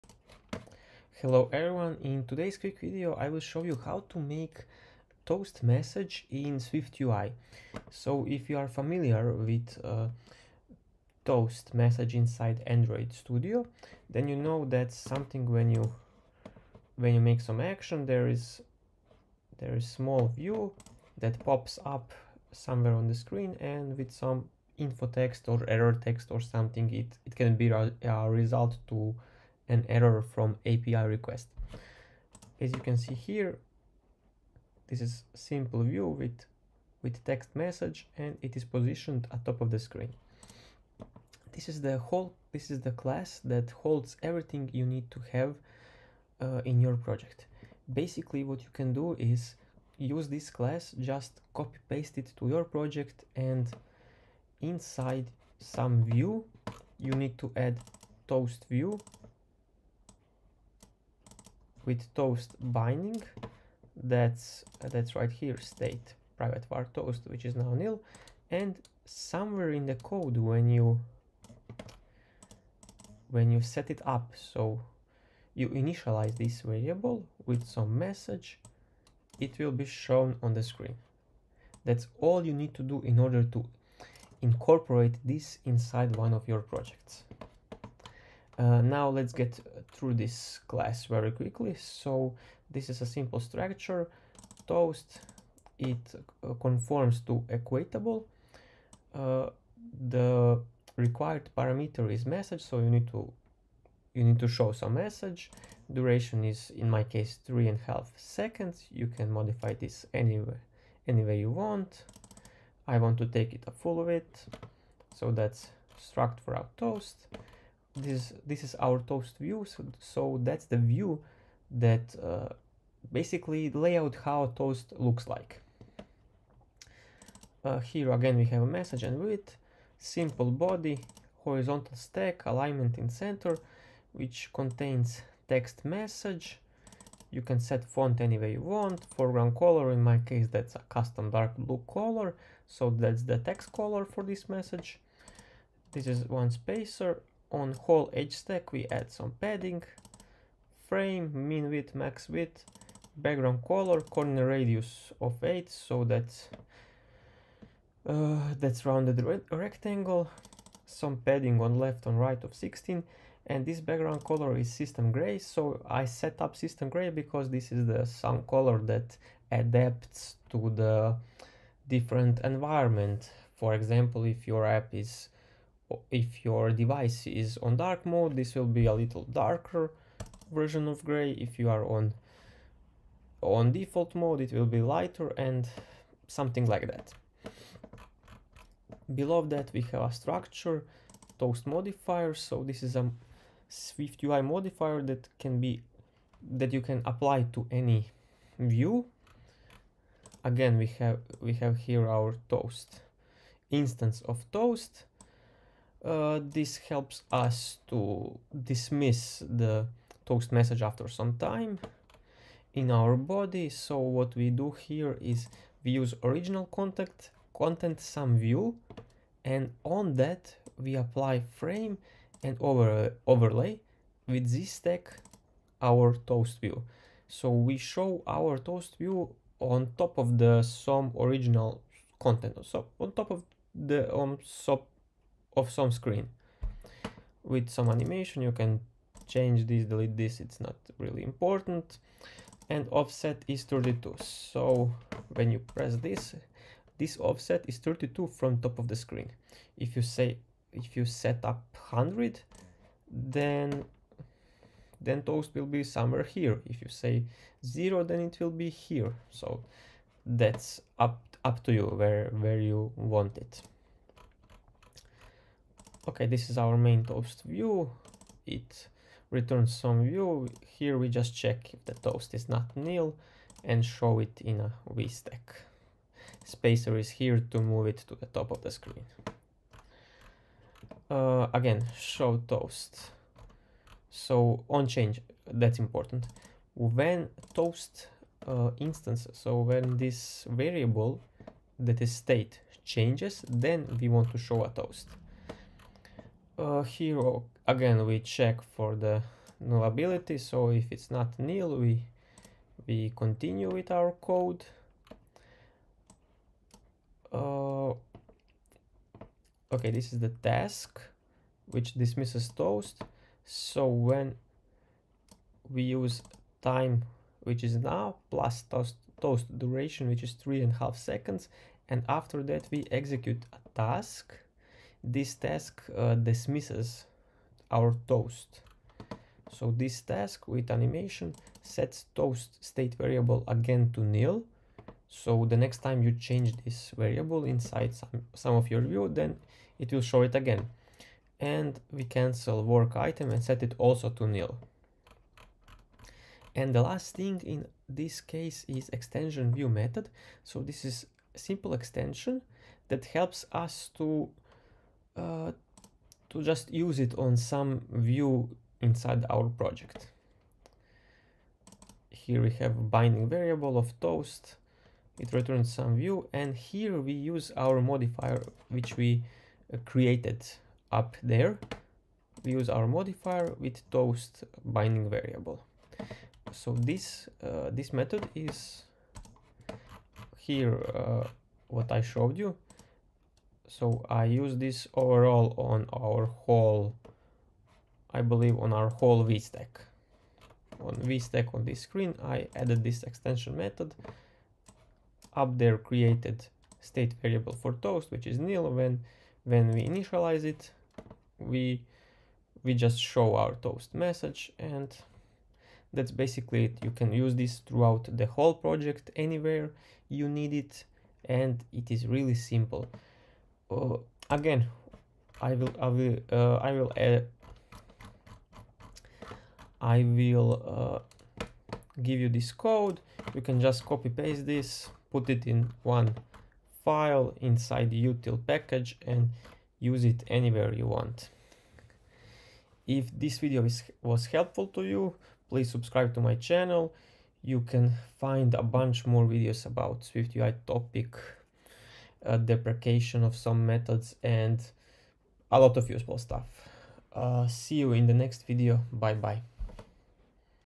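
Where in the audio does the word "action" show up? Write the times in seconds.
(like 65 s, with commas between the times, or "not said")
17 s.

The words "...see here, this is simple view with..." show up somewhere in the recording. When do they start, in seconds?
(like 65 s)
32 s.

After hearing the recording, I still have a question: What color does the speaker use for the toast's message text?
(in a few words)
custom dark blue.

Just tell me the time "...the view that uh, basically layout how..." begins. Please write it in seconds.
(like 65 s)
120 s.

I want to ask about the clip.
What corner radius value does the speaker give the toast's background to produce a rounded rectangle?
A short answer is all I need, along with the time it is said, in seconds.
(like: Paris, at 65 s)
8, at 154 s.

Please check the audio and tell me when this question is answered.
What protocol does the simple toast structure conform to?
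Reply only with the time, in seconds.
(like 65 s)
97 s.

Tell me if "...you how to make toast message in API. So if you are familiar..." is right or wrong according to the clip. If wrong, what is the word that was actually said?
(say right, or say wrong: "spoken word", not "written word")
wrong: "SwiftUI", not "API".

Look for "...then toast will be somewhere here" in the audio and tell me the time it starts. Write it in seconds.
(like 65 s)
255 s.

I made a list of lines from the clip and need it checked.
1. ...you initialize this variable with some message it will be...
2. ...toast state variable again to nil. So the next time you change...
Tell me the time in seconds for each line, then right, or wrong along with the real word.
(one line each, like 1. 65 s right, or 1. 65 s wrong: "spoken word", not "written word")
1. 75 s right
2. 332 s right.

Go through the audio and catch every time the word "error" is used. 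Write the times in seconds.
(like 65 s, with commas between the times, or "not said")
25 s, 29 s.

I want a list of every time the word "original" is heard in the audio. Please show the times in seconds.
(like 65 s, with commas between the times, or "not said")
216 s, 231 s.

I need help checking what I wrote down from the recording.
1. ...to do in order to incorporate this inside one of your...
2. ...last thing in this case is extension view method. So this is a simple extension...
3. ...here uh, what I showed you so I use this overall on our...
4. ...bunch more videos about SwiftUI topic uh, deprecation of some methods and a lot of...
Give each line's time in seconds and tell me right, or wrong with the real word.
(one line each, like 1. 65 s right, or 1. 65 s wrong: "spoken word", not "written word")
1. 82 s right
2. 346 s right
3. 380 s right
4. 438 s right.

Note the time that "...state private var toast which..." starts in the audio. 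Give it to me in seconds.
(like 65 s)
65 s.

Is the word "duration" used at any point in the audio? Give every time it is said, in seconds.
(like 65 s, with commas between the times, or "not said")
105 s, 319 s.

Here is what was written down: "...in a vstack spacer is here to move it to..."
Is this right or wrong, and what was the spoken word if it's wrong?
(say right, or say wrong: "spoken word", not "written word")
right.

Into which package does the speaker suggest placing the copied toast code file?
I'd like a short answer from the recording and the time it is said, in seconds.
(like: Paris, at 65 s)
util package, at 427 s.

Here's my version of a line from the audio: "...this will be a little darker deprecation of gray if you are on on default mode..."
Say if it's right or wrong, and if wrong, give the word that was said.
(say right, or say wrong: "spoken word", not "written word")
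wrong: "version", not "deprecation".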